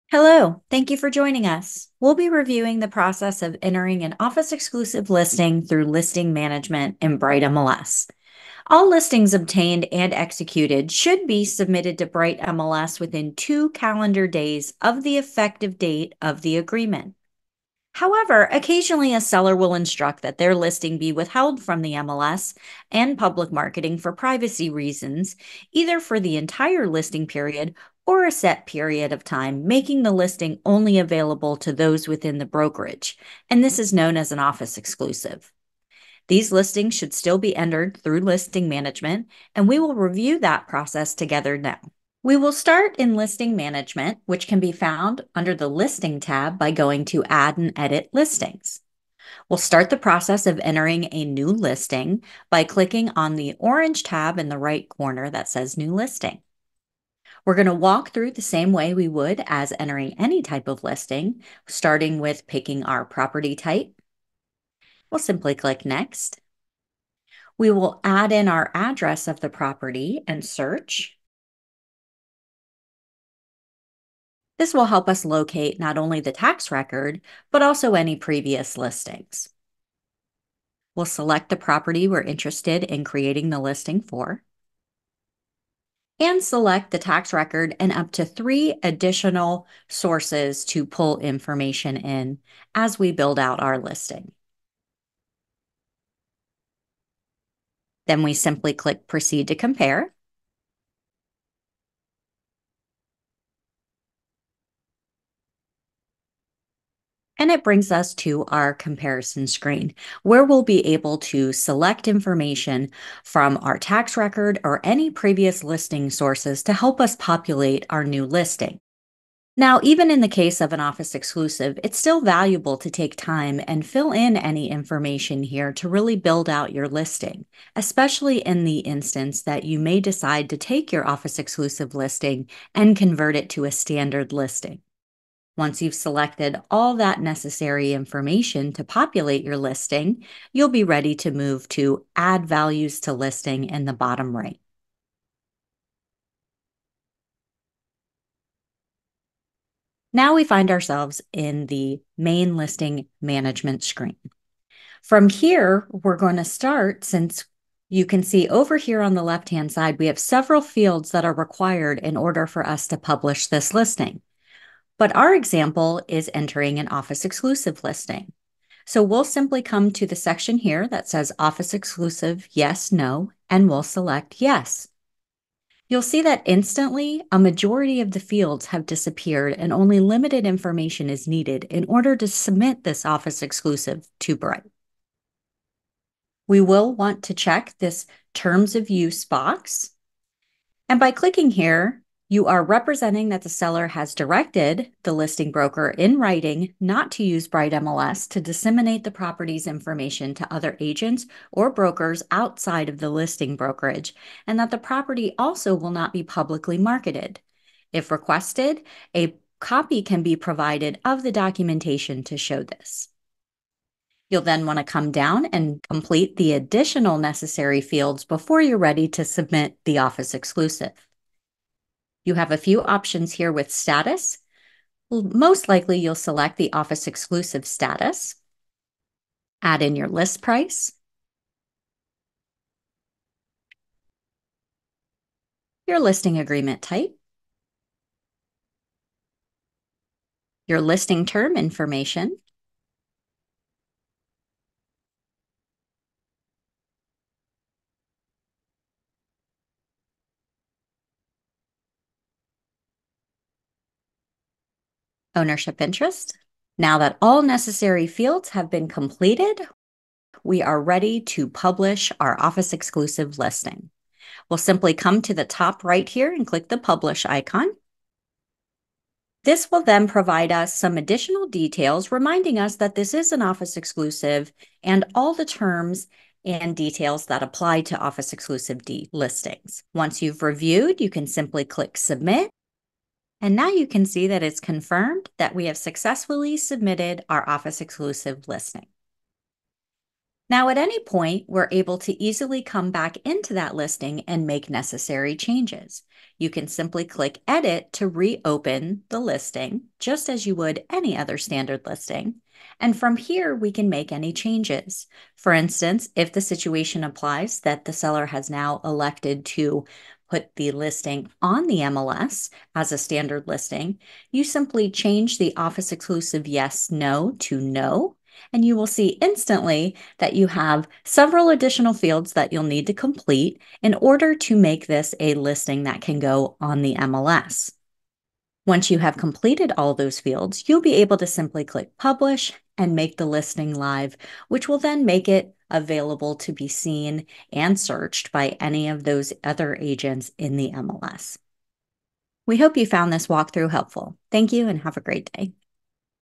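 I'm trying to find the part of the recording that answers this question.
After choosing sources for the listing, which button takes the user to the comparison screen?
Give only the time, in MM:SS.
01:39.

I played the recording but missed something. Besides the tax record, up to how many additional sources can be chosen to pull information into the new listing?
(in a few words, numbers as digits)
3.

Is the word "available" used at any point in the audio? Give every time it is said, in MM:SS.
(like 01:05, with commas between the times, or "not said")
00:30, 05:35.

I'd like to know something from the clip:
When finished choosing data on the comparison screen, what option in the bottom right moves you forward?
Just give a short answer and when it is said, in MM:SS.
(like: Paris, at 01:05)
Add Values to Listing, at 02:22.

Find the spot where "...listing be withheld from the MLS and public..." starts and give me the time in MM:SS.
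00:20.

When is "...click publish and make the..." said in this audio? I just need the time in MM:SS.
05:31.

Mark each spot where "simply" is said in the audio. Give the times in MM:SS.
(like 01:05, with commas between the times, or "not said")
01:05, 01:38, 02:49, 04:24, 04:41, 04:56, 05:14, 05:31.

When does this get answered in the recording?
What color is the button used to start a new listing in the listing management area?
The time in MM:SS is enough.
00:53.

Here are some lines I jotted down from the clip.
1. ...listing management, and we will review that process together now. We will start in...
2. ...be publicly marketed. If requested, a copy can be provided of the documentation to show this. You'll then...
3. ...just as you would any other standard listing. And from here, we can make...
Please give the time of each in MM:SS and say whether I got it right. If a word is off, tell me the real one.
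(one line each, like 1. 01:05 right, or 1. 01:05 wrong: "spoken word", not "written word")
1. 00:38 right
2. 03:26 right
3. 04:59 right.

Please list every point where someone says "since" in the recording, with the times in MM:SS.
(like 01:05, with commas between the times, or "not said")
02:37.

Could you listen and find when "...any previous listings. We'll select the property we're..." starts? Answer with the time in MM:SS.
01:17.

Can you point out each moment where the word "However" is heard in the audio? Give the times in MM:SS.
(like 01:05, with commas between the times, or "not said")
00:17.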